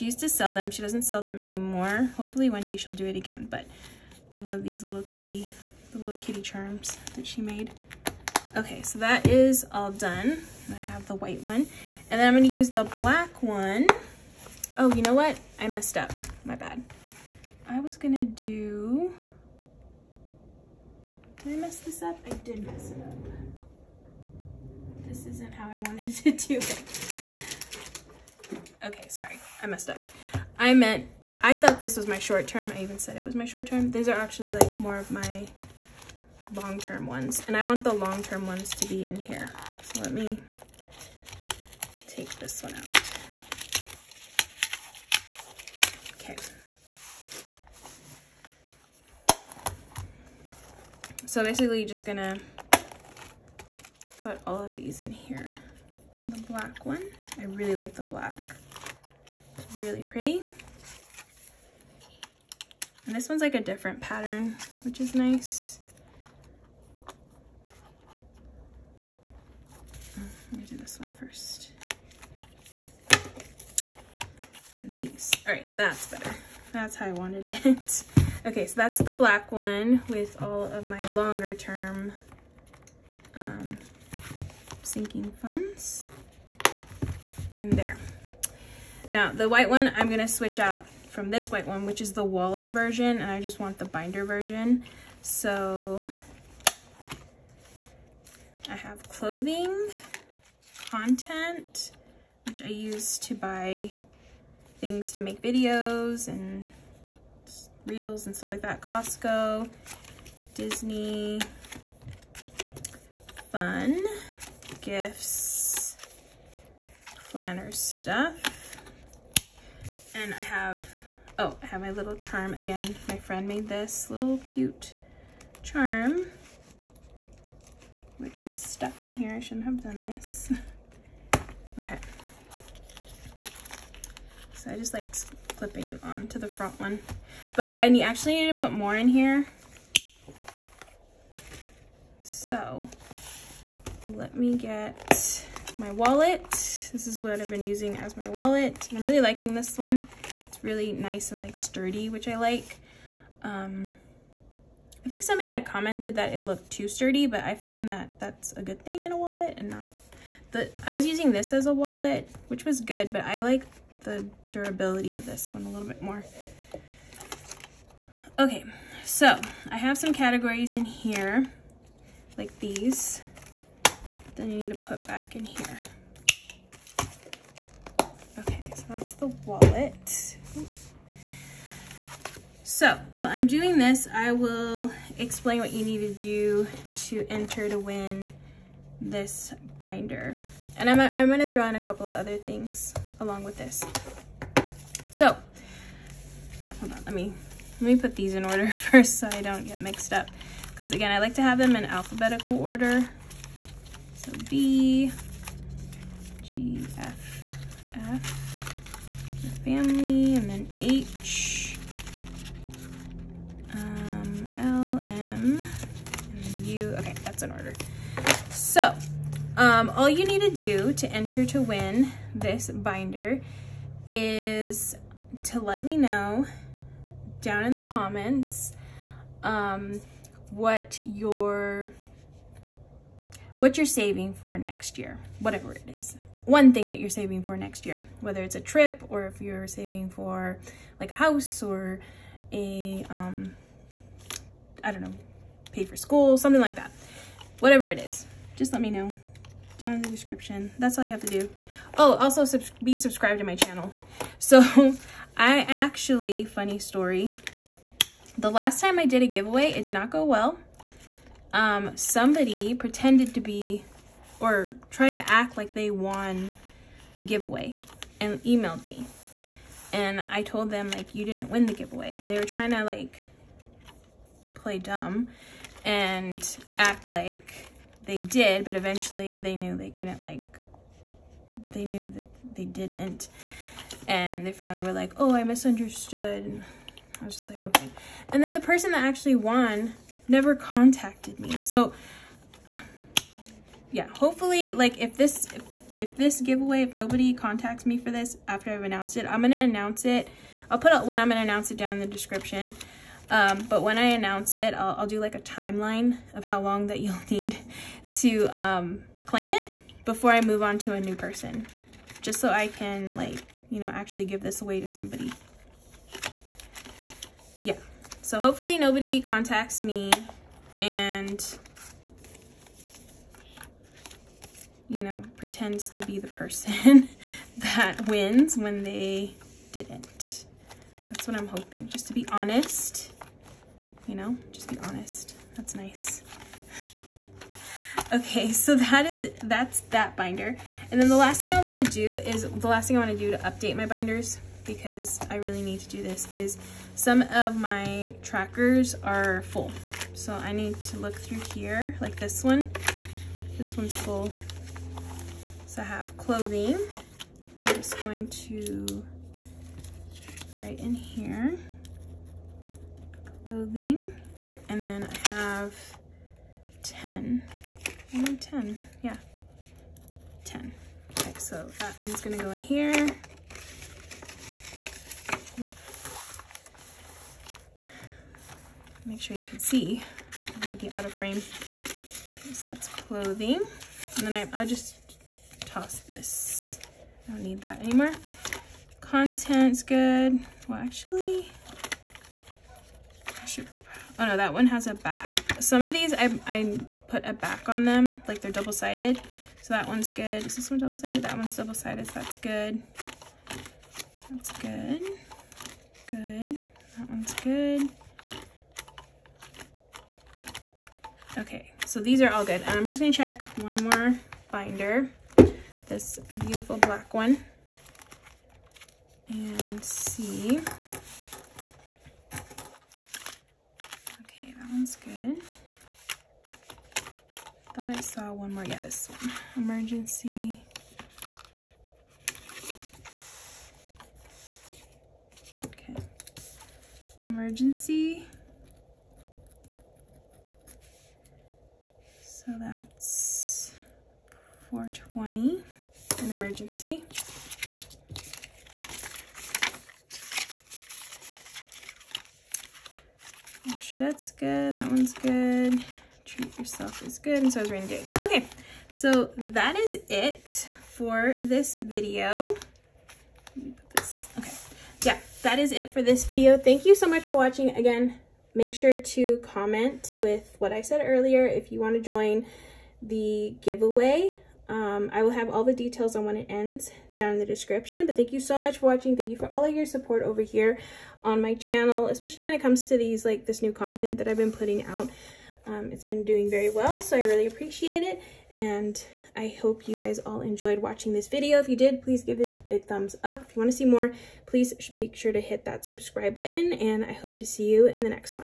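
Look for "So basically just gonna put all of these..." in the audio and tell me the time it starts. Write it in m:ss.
0:51.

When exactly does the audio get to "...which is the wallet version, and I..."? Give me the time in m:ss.
1:31.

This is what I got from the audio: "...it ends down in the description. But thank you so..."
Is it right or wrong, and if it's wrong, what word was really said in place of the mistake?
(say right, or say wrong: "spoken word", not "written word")
right.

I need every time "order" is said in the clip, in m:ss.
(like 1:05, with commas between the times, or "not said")
3:18, 3:22, 3:37.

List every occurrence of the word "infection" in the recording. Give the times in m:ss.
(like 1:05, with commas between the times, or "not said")
not said.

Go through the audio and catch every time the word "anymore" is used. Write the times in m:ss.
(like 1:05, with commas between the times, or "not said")
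0:01, 6:27.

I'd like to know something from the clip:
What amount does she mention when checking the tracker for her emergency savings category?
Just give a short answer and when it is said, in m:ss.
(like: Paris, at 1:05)
420, at 7:24.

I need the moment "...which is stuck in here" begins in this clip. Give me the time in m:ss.
2:08.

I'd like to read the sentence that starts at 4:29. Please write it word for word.
And I told them, like, you didn't win the giveaway.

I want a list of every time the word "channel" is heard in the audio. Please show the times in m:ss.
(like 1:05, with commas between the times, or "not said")
4:13, 8:01.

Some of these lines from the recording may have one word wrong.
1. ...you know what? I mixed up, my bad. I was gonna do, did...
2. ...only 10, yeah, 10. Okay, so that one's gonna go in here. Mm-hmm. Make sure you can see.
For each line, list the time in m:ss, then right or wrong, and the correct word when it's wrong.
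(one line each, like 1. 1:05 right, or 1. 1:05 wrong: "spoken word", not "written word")
1. 0:14 wrong: "messed", not "mixed"
2. 6:08 right.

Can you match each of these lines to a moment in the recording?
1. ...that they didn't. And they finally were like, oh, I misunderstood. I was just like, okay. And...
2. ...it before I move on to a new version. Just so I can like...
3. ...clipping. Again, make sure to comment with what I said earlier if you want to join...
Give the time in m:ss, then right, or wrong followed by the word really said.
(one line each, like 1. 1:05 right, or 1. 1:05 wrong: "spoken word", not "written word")
1. 4:42 right
2. 5:09 wrong: "person", not "version"
3. 7:47 wrong: "watching", not "clipping".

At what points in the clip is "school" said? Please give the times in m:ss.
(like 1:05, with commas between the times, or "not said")
4:05.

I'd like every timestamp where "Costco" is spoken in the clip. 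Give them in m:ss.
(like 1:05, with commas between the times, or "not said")
1:48.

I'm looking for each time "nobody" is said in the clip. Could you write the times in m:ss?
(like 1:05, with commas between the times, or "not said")
4:56, 5:18.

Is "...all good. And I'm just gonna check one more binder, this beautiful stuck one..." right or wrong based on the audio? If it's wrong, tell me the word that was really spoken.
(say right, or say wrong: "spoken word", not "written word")
wrong: "black", not "stuck".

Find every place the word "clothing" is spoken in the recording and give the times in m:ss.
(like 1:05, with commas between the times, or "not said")
1:39, 5:56, 6:03, 6:22.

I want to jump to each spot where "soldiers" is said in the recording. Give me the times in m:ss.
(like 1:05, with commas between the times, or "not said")
not said.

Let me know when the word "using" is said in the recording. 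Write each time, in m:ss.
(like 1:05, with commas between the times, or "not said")
2:27, 2:41.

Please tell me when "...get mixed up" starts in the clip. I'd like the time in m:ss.
3:19.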